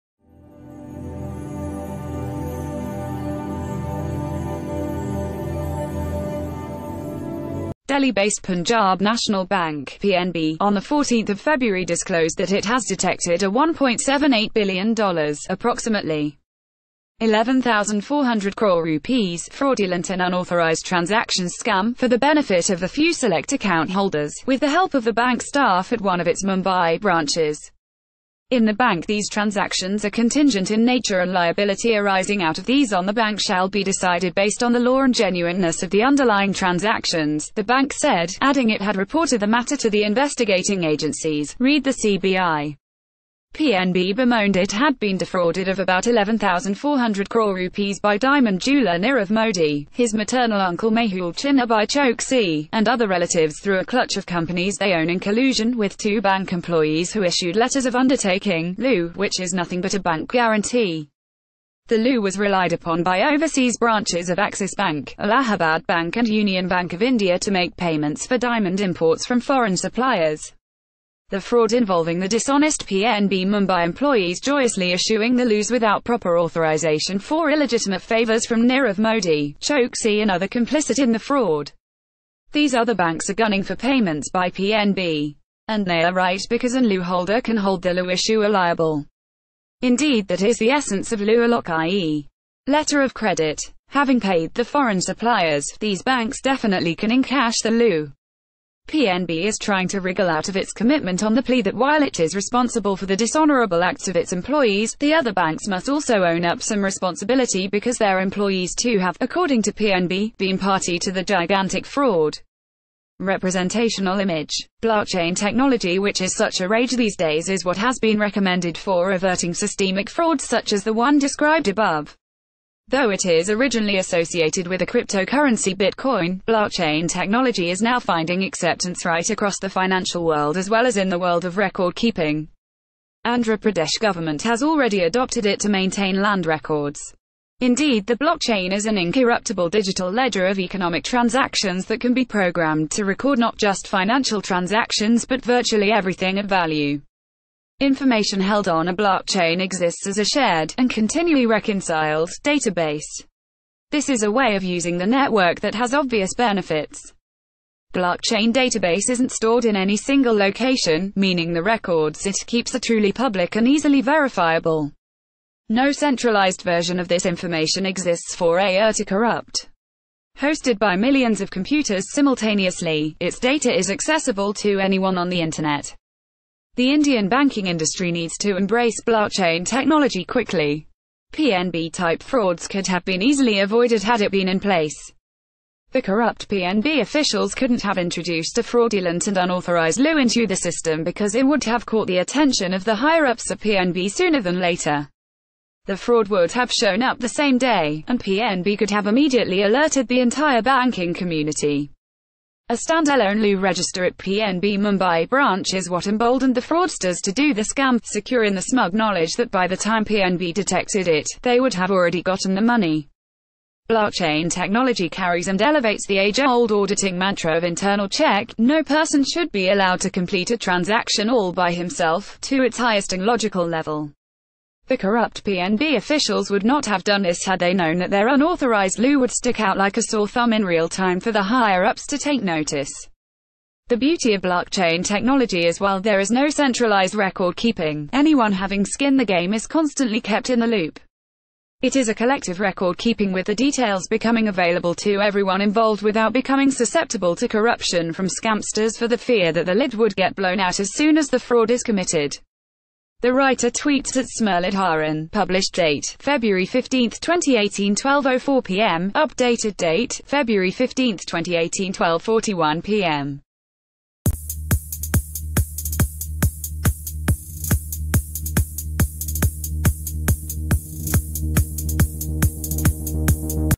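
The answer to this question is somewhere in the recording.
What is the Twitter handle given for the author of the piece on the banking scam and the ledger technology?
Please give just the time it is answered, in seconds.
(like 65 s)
254 s.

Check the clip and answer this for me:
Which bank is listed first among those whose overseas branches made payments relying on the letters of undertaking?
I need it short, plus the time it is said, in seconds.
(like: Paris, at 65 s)
Axis Bank, at 64 s.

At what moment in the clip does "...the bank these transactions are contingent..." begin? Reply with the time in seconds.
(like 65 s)
28 s.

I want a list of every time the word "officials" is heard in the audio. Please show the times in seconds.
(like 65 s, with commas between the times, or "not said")
187 s, 225 s.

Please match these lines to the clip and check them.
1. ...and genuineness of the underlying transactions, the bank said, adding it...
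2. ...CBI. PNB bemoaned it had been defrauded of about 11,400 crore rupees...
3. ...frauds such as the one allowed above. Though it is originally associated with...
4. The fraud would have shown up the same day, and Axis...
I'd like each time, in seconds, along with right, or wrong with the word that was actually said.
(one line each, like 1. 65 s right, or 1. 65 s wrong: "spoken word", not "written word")
1. 35 s right
2. 41 s right
3. 120 s wrong: "described", not "allowed"
4. 195 s wrong: "PNB", not "Axis".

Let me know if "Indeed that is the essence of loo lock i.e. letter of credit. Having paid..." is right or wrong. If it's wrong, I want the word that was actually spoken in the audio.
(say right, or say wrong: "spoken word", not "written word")
right.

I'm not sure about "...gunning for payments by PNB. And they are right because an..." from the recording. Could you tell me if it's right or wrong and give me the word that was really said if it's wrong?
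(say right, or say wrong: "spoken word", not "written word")
right.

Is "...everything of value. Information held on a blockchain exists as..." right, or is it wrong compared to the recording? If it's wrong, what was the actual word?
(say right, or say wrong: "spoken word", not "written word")
right.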